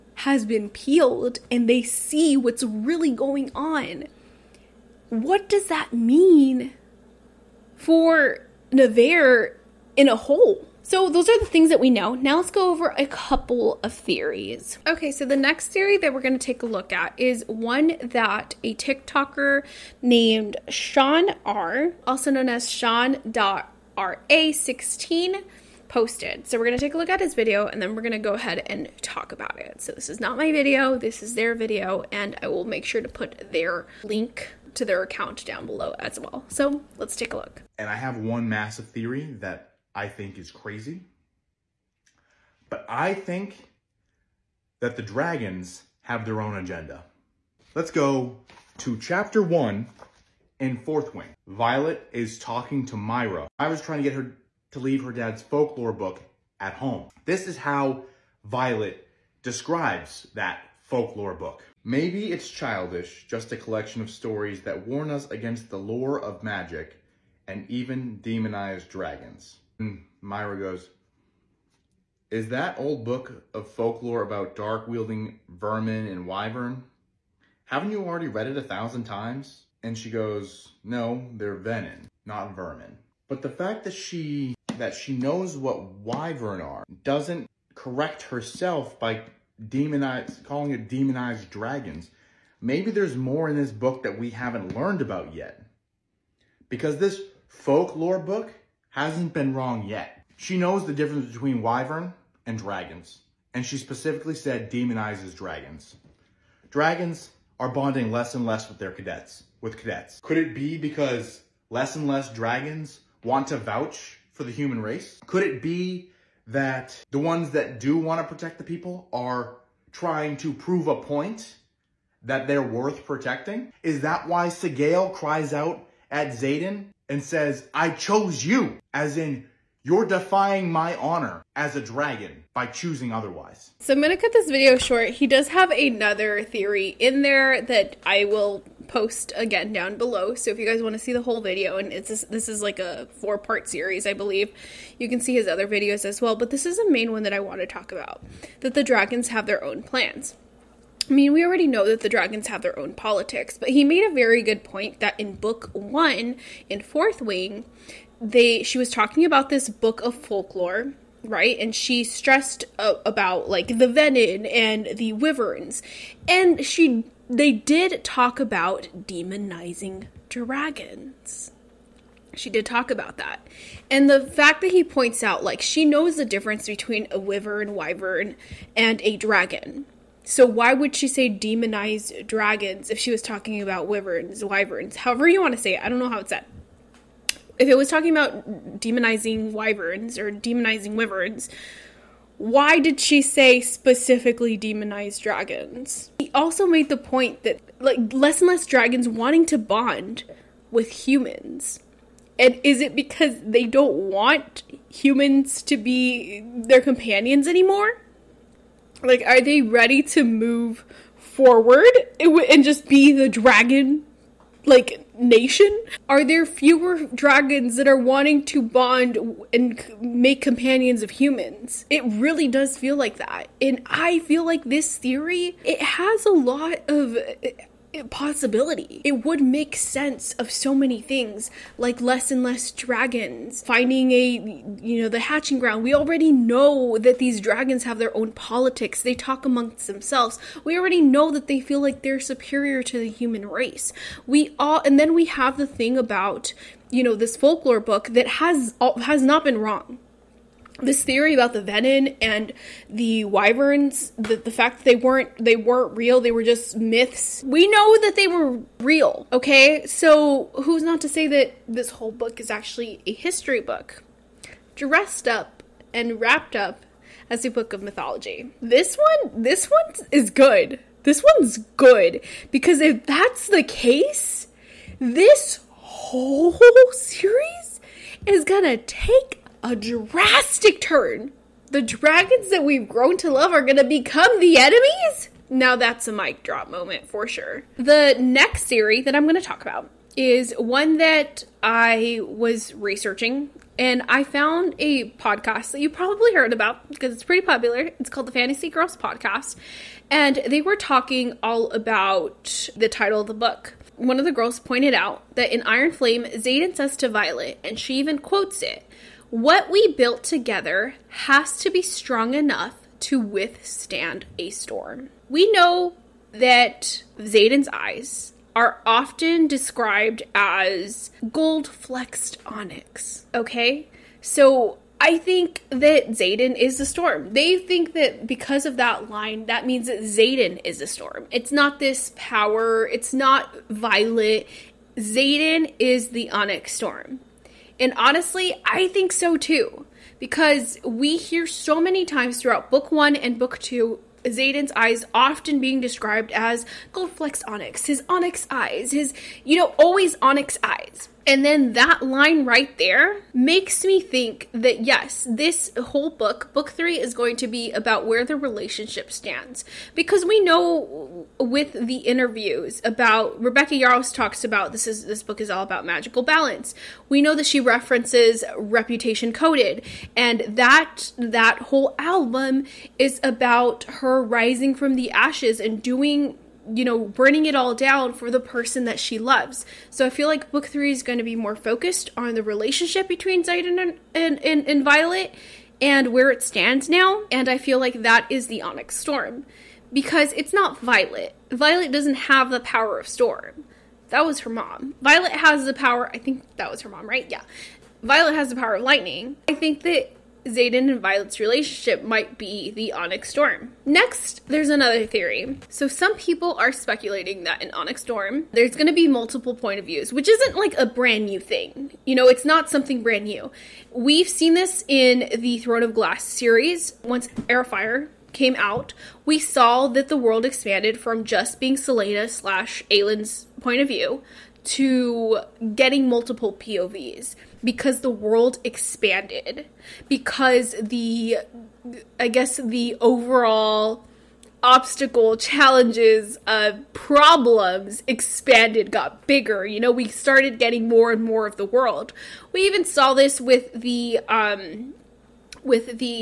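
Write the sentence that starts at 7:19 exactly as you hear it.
You know, we started getting more and more of the world.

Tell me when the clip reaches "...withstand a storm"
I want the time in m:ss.
5:13.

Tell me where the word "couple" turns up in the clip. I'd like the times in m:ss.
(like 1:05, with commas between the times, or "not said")
0:13.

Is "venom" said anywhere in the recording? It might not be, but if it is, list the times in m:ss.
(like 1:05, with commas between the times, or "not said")
1:21, 4:11.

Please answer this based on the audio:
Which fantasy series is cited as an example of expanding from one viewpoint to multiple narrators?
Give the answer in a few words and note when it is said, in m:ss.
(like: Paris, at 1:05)
Throne of Glass, at 6:55.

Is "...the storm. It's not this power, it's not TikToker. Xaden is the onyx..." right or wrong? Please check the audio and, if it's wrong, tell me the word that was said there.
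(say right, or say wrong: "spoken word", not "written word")
wrong: "Violet", not "TikToker".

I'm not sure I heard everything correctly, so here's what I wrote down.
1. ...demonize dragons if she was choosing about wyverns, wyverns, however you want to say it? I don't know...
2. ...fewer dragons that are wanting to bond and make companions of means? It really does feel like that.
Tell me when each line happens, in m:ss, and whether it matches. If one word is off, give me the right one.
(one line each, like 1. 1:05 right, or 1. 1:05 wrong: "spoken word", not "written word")
1. 3:01 wrong: "talking", not "choosing"
2. 3:36 wrong: "humans", not "means".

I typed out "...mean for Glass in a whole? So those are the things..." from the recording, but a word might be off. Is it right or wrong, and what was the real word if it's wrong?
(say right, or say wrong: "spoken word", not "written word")
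wrong: "Navarre", not "Glass".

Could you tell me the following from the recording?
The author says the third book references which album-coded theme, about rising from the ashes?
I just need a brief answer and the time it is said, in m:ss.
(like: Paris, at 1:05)
reputation, at 6:08.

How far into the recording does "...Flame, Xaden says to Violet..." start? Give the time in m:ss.
5:05.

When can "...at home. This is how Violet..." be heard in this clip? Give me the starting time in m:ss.
0:56.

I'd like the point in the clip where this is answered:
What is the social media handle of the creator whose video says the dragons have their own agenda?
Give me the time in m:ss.
0:22.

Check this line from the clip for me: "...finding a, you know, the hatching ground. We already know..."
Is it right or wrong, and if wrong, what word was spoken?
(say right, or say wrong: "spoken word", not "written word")
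right.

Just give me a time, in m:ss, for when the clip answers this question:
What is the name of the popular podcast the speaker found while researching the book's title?
4:58.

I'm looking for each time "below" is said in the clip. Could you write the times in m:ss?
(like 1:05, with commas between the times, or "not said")
0:35, 2:19.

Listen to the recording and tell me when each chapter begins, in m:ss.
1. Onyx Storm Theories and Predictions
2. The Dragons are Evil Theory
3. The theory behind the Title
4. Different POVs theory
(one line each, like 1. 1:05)
1. 0:10
2. 0:40
3. 4:48
4. 6:45.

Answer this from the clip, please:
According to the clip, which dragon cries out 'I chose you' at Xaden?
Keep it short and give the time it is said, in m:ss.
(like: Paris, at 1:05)
Sgaeyl, at 2:04.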